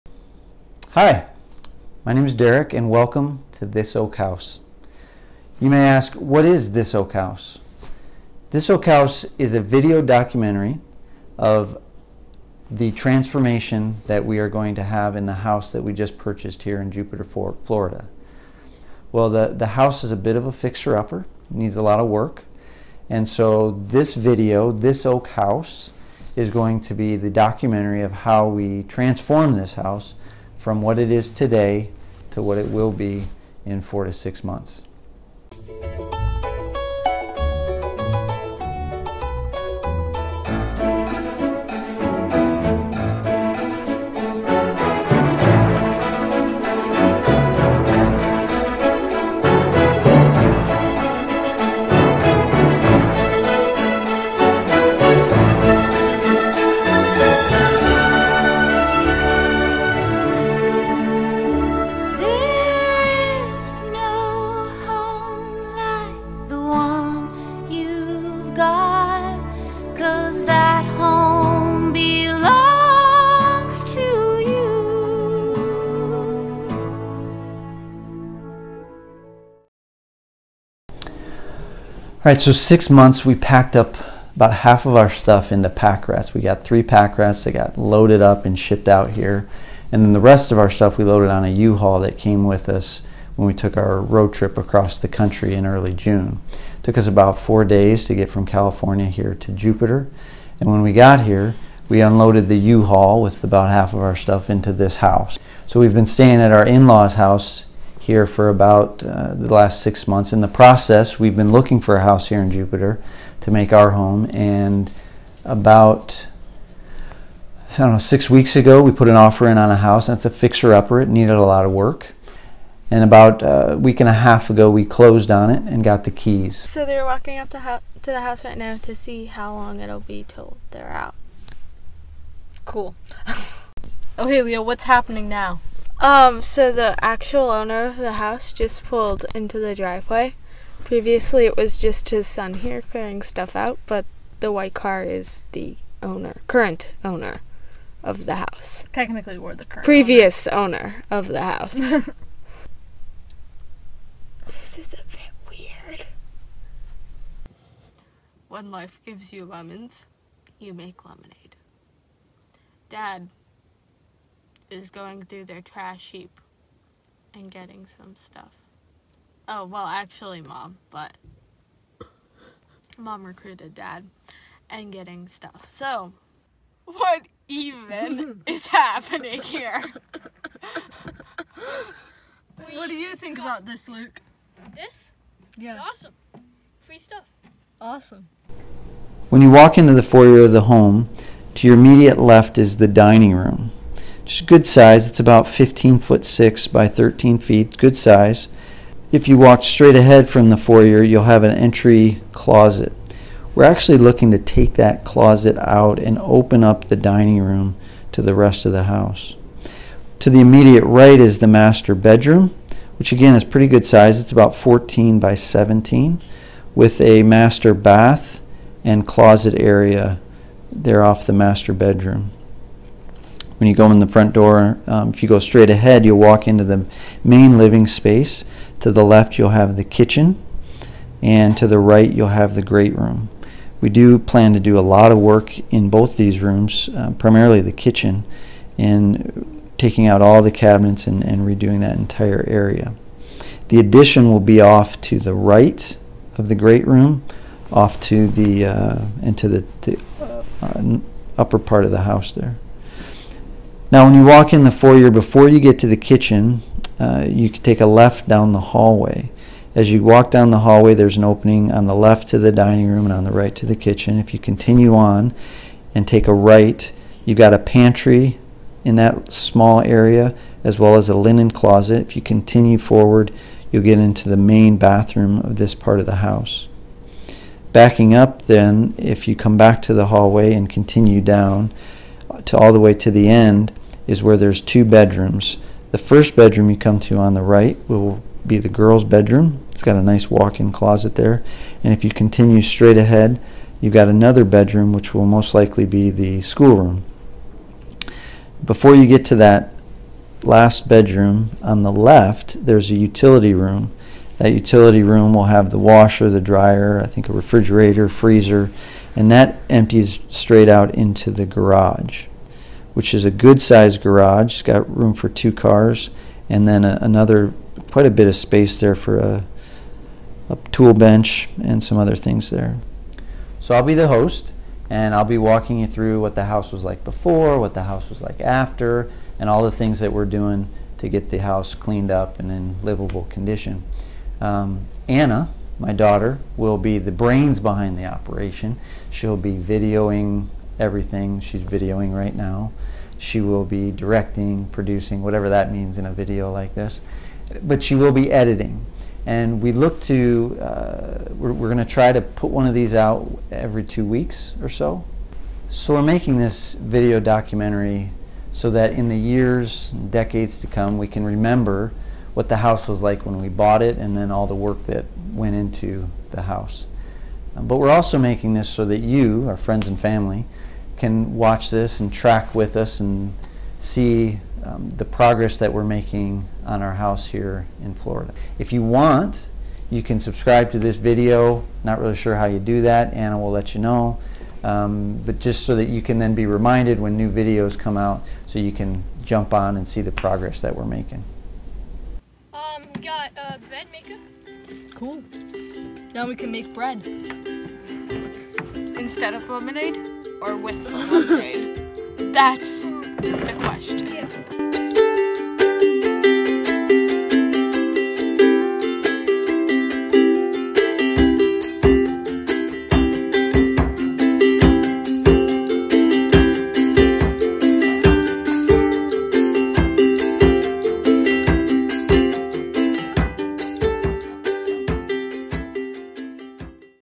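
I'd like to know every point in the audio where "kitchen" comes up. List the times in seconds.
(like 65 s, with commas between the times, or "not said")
229 s, 237 s, 255 s, 263 s.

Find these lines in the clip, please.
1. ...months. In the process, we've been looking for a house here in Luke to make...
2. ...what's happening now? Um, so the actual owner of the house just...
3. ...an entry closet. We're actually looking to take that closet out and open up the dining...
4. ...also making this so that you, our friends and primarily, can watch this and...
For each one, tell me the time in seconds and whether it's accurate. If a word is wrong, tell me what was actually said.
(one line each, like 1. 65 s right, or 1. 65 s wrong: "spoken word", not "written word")
1. 110 s wrong: "Jupiter", not "Luke"
2. 134 s right
3. 201 s right
4. 367 s wrong: "family", not "primarily".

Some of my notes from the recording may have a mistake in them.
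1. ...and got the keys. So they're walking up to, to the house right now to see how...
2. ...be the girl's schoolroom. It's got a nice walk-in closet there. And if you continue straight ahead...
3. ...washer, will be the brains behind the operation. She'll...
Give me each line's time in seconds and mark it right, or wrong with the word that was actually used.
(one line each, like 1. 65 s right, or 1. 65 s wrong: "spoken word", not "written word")
1. 125 s right
2. 288 s wrong: "bedroom", not "schoolroom"
3. 335 s wrong: "daughter", not "washer".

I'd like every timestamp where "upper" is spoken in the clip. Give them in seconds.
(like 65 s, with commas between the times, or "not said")
20 s, 120 s, 251 s.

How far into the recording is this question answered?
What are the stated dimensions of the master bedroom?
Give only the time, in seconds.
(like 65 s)
214 s.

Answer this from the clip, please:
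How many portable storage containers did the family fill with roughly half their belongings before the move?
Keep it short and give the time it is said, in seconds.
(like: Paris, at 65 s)
3, at 86 s.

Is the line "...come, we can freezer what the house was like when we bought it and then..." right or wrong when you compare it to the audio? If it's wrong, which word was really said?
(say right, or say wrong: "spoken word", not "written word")
wrong: "remember", not "freezer".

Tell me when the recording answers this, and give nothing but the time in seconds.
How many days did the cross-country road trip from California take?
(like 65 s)
97 s.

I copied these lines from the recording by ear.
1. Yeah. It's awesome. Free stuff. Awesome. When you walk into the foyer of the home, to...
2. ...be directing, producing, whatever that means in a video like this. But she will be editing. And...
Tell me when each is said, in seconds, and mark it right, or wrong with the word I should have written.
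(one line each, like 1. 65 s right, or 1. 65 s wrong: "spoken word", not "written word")
1. 185 s right
2. 343 s right.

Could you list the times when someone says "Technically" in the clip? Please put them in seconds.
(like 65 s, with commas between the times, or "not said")
148 s.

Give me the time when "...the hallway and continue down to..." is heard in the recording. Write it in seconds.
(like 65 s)
279 s.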